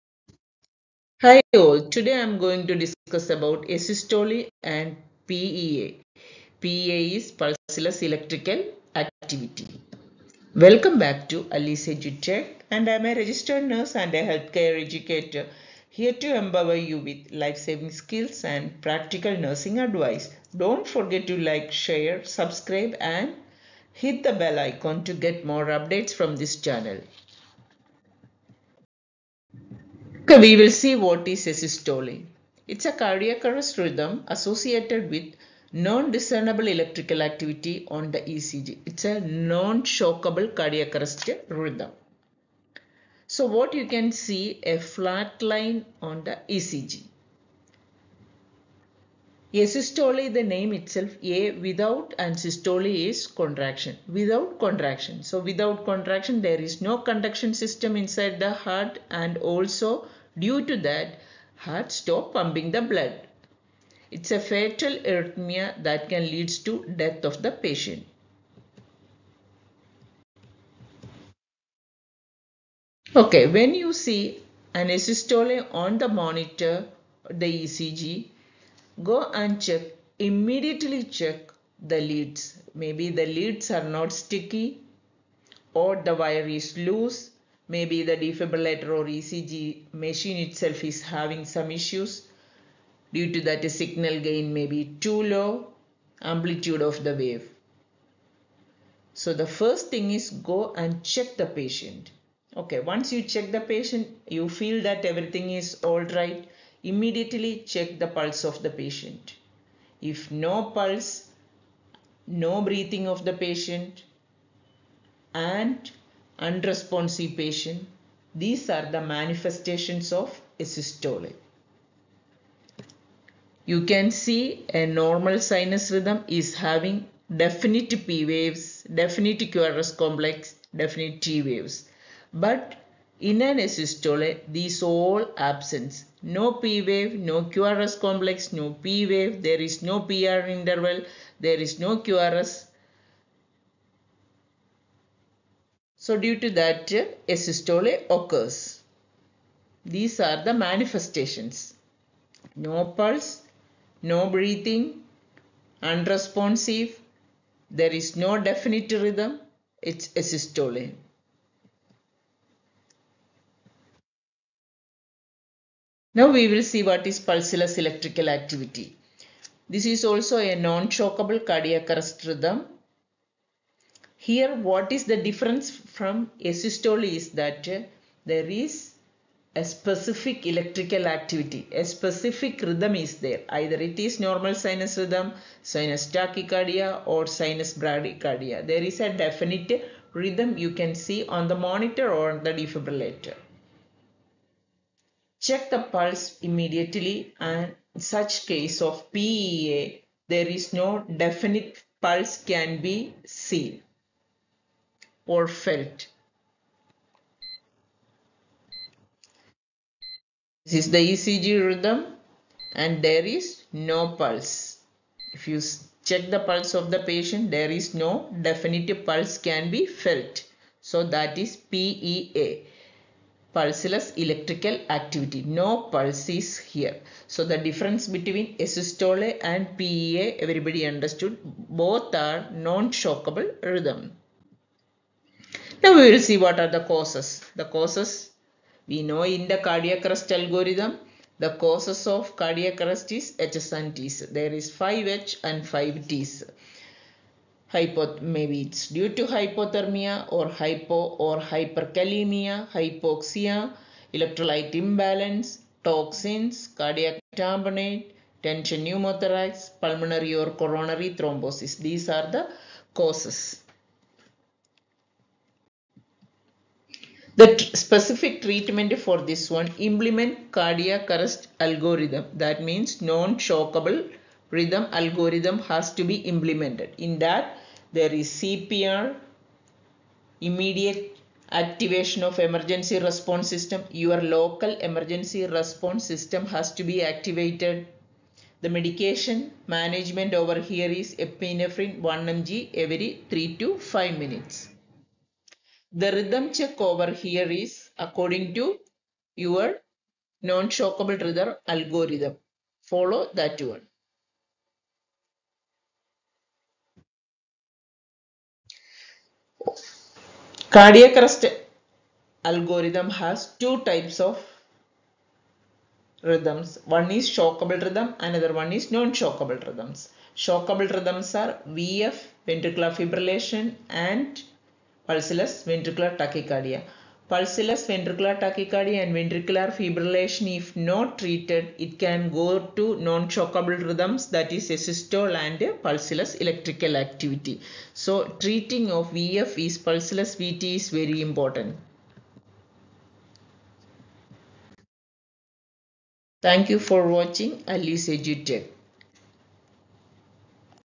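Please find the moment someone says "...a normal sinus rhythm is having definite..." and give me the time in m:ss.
2:04.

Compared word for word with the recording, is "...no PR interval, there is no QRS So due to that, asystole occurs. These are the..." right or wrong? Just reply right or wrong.
right.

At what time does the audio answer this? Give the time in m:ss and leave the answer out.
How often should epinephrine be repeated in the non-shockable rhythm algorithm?
4:52.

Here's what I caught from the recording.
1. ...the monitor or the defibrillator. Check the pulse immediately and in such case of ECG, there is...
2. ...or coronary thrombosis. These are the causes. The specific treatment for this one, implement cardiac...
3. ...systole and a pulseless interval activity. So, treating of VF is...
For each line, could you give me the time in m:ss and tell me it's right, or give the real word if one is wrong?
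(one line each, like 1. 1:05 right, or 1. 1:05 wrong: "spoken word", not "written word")
1. 3:11 wrong: "PEA", not "ECG"
2. 4:20 right
3. 5:34 wrong: "electrical", not "interval".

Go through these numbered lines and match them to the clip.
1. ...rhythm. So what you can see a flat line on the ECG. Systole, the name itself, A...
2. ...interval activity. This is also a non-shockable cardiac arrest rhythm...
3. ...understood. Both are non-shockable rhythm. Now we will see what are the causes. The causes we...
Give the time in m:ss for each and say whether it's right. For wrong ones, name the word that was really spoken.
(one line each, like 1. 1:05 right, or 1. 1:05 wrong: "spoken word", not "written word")
1. 0:41 right
2. 2:47 wrong: "electrical", not "interval"
3. 3:50 right.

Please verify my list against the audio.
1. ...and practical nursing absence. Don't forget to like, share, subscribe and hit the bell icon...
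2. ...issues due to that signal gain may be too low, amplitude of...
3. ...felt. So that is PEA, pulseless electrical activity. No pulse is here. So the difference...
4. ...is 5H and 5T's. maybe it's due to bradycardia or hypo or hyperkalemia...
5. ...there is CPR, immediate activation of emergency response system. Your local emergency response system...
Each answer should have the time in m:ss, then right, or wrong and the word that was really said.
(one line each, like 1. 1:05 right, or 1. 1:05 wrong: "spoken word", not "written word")
1. 0:18 wrong: "advice", not "absence"
2. 1:31 right
3. 3:39 right
4. 4:04 wrong: "hypothermia", not "bradycardia"
5. 4:37 right.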